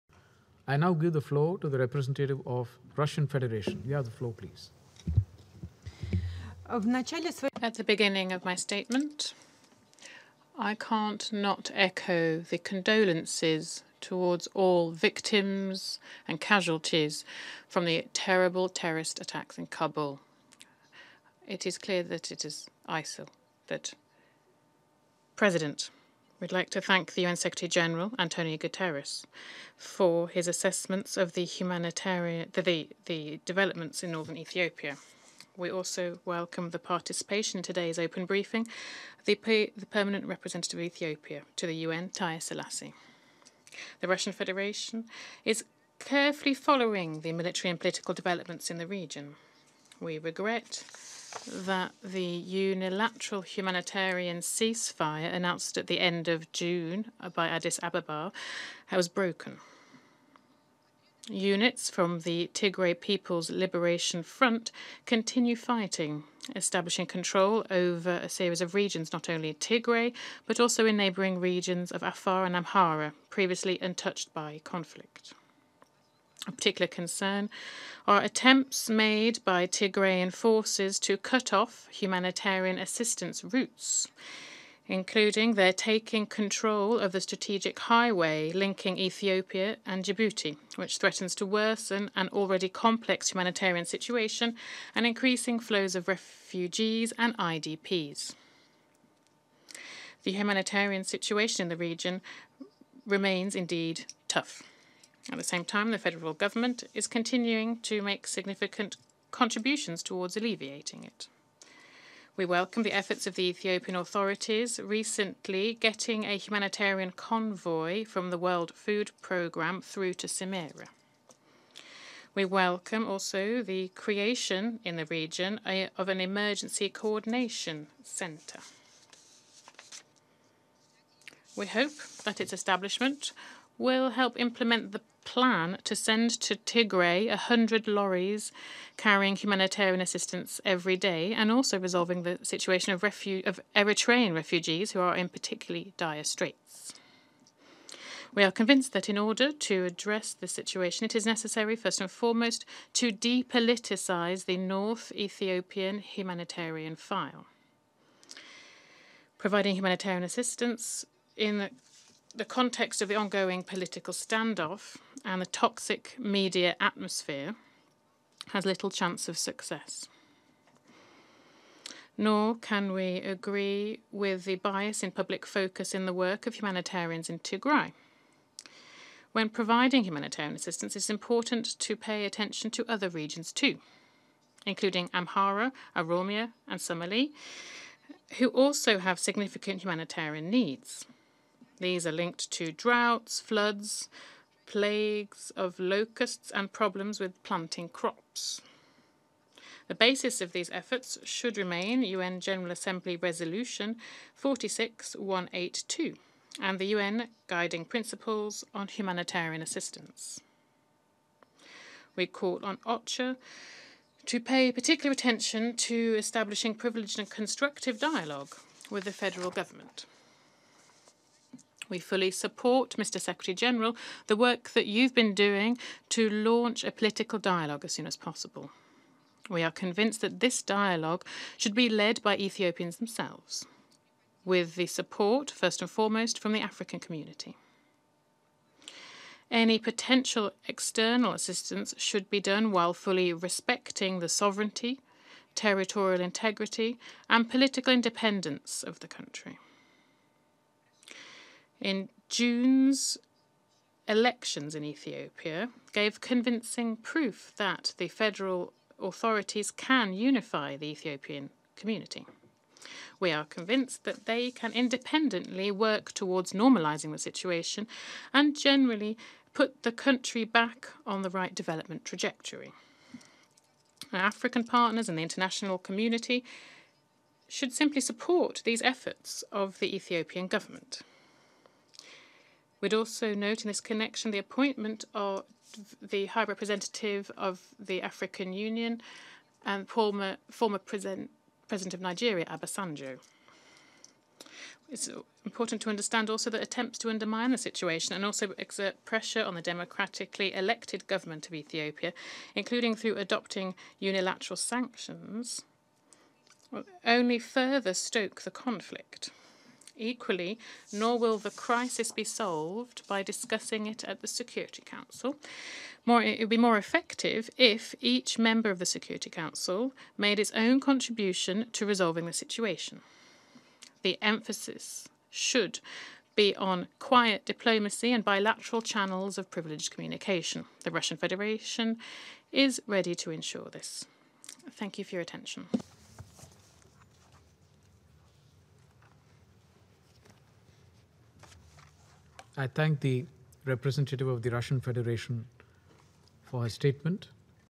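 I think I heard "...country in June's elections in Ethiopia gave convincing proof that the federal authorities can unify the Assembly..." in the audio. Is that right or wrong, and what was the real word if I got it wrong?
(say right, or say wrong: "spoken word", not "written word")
wrong: "Ethiopian", not "Assembly".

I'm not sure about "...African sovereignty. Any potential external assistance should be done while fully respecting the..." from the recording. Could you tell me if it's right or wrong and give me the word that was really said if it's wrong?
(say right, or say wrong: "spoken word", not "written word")
wrong: "community", not "sovereignty".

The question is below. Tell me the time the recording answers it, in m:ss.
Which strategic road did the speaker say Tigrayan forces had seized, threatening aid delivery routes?
1:27.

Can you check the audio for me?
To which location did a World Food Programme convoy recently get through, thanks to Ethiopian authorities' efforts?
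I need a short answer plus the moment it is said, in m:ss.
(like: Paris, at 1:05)
Semera, at 2:00.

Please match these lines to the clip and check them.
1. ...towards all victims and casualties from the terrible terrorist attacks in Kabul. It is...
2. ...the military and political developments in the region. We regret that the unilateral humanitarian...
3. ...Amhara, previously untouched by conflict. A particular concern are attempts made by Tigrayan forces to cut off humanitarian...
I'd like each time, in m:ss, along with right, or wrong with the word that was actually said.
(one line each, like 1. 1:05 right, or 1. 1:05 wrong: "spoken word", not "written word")
1. 0:13 right
2. 0:47 right
3. 1:12 right.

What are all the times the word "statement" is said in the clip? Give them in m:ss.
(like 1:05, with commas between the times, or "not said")
0:08, 5:46.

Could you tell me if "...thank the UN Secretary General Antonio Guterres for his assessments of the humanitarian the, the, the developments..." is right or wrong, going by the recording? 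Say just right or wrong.
right.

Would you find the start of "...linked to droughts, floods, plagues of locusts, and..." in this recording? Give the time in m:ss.
3:12.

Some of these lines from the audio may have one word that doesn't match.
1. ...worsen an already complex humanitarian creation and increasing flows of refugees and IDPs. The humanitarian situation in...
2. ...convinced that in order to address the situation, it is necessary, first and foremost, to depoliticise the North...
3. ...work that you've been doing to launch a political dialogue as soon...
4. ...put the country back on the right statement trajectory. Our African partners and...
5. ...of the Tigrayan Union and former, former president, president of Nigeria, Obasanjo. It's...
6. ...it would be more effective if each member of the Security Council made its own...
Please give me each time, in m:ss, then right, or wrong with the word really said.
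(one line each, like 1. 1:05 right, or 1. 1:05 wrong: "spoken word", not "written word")
1. 1:31 wrong: "situation", not "creation"
2. 2:28 right
3. 3:44 right
4. 4:29 wrong: "development", not "statement"
5. 4:47 wrong: "African", not "Tigrayan"
6. 5:16 right.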